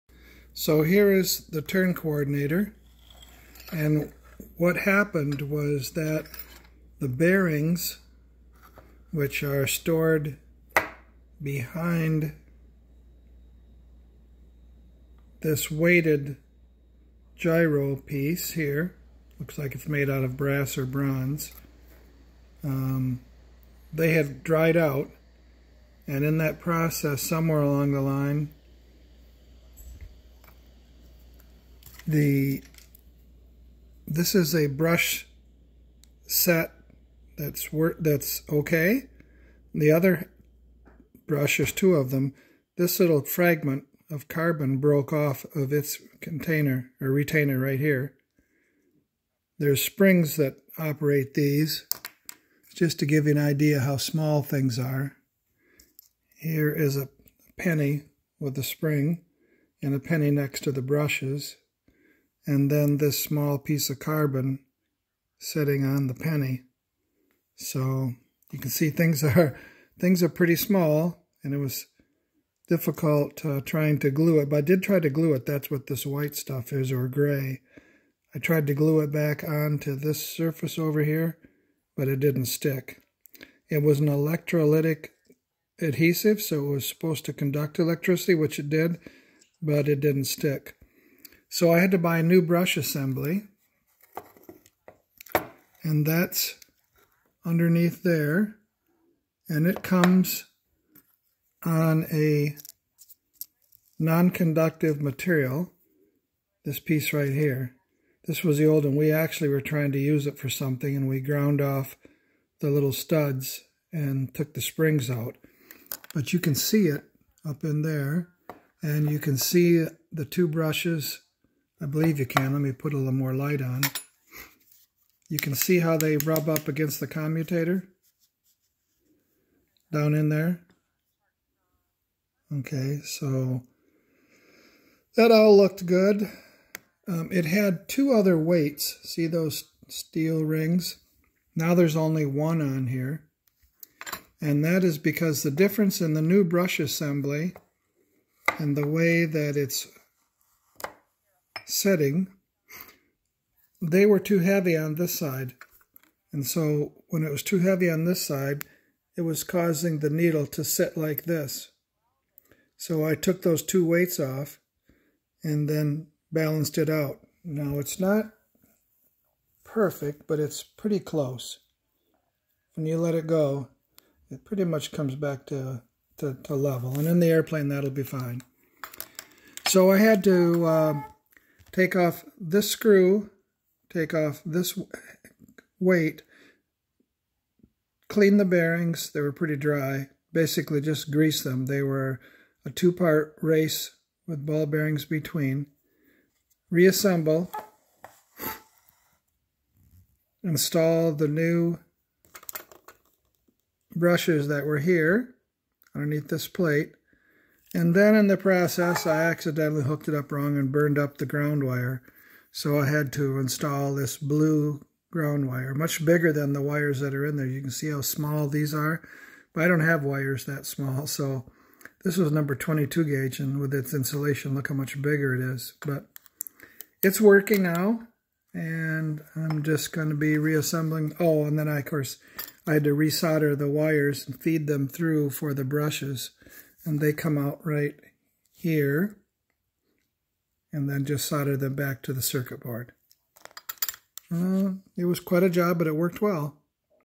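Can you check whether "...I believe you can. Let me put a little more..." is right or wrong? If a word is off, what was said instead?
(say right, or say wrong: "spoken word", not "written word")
right.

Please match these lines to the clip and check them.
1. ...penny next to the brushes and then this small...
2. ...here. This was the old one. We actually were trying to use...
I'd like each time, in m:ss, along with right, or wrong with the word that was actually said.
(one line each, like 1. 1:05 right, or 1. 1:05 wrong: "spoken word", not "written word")
1. 0:59 right
2. 1:47 right.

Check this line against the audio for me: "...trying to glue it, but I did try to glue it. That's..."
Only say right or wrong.
right.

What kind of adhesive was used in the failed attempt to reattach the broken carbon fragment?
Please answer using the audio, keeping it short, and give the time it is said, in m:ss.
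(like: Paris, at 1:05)
electrolytic adhesive, at 1:24.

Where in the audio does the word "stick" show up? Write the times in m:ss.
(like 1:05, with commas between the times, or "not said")
1:22, 1:30.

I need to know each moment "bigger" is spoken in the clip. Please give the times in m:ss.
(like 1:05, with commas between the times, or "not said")
3:36, 3:45.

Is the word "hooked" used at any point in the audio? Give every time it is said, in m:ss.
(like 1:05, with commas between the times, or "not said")
3:29.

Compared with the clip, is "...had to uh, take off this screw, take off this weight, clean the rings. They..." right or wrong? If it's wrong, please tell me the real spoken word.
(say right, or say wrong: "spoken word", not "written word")
wrong: "bearings", not "rings".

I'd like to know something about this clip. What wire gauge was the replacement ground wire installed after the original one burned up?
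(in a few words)
22.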